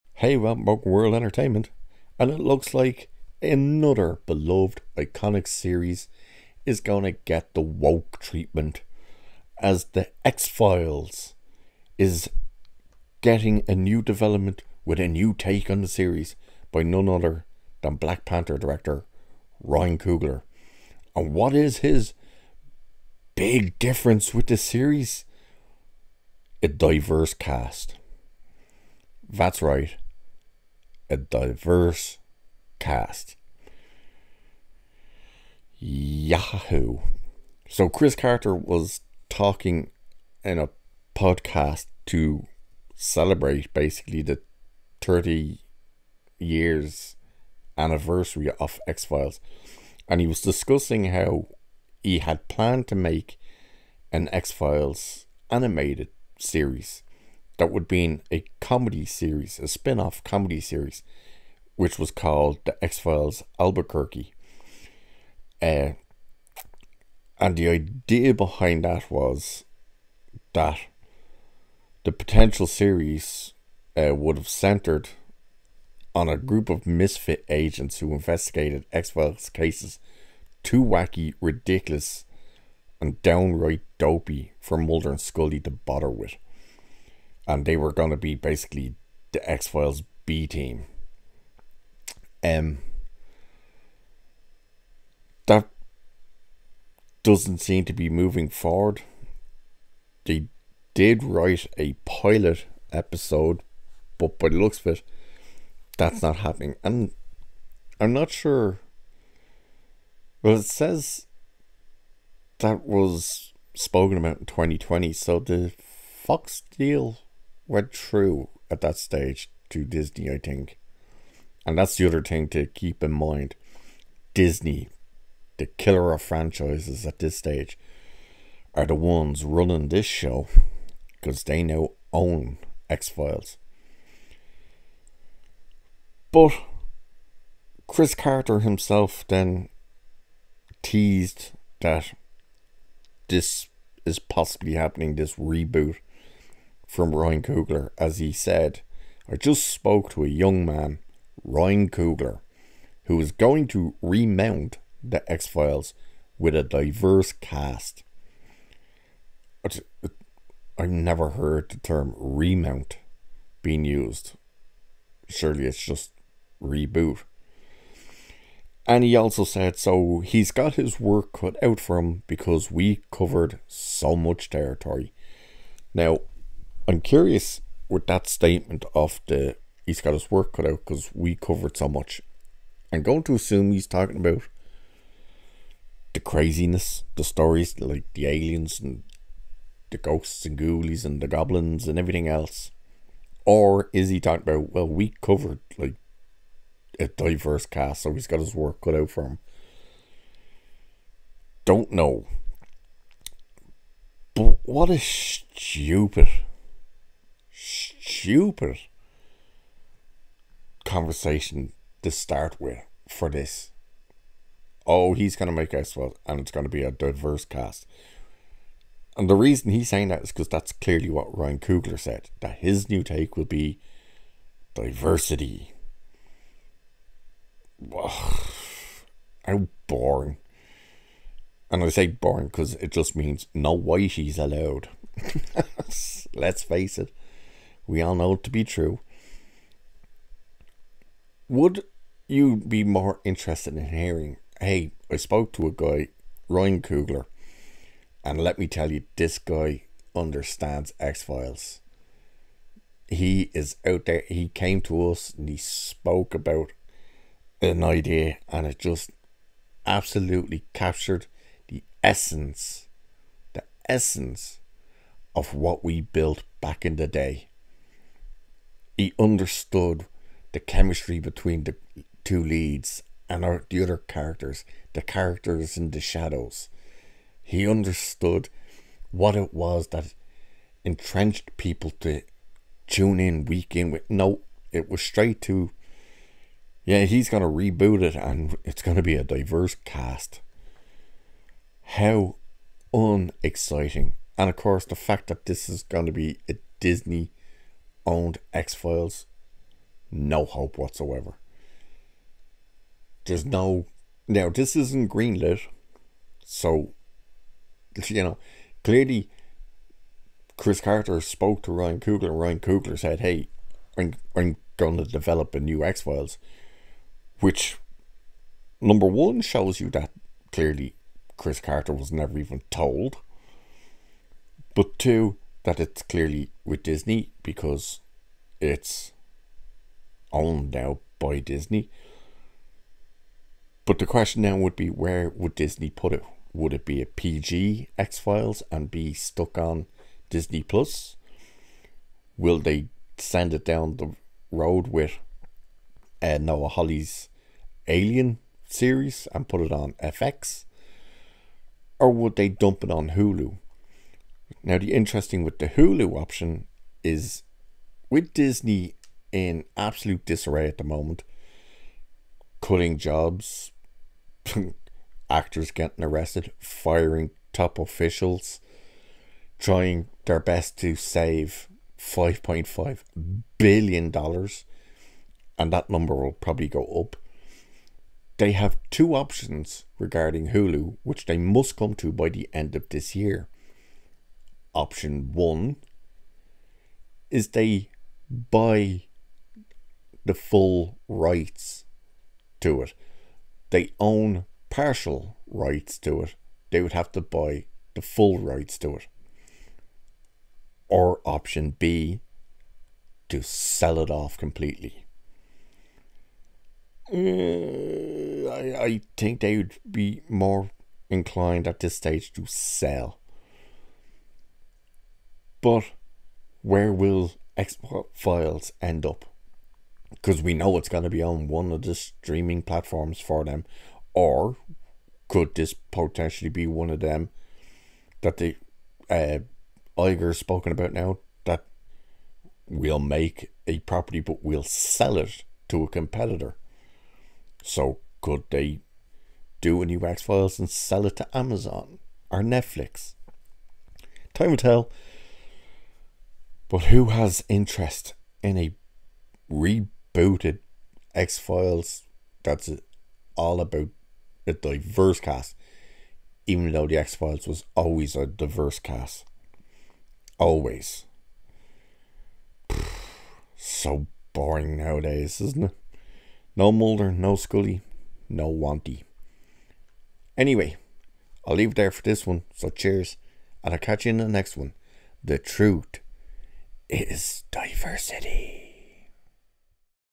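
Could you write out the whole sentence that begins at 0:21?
And what is his big difference with the series?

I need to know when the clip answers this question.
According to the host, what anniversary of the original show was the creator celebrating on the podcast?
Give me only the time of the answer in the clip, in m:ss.
0:45.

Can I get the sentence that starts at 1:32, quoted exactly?
Um, that doesn't seem to be moving forward.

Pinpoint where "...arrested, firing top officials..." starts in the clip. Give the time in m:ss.
6:06.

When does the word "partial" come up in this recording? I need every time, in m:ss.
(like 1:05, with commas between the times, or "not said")
6:34.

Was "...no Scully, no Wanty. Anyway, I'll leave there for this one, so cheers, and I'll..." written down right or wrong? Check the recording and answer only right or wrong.
right.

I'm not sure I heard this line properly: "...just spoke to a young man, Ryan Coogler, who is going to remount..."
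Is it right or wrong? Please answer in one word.
right.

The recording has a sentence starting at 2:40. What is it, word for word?
I've never heard the term remount being used.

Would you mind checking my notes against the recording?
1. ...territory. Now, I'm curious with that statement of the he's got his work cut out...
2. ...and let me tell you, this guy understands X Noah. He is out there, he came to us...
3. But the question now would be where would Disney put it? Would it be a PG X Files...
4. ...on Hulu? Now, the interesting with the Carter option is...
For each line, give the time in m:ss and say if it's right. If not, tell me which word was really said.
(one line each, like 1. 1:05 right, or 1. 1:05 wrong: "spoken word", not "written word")
1. 2:54 right
2. 4:08 wrong: "Files", not "Noah"
3. 5:33 right
4. 5:52 wrong: "Hulu", not "Carter".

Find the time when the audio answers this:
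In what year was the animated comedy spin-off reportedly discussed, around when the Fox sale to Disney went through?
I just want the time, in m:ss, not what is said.
1:54.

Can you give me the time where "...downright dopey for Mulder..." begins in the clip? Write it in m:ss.
1:23.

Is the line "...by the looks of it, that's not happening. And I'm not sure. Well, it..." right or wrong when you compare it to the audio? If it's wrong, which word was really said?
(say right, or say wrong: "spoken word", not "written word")
right.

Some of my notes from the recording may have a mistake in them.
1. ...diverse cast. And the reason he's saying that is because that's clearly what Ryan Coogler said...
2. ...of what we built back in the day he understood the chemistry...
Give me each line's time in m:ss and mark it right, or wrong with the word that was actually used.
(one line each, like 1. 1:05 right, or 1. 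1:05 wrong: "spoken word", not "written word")
1. 3:36 right
2. 4:25 right.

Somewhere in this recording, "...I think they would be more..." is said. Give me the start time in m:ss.
6:48.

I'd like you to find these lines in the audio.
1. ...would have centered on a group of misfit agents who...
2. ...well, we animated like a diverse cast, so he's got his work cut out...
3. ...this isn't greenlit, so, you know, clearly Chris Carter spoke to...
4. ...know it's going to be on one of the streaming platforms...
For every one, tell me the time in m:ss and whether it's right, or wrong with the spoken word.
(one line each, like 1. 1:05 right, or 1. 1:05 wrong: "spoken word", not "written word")
1. 1:14 right
2. 3:14 wrong: "covered", not "animated"
3. 5:04 right
4. 7:00 right.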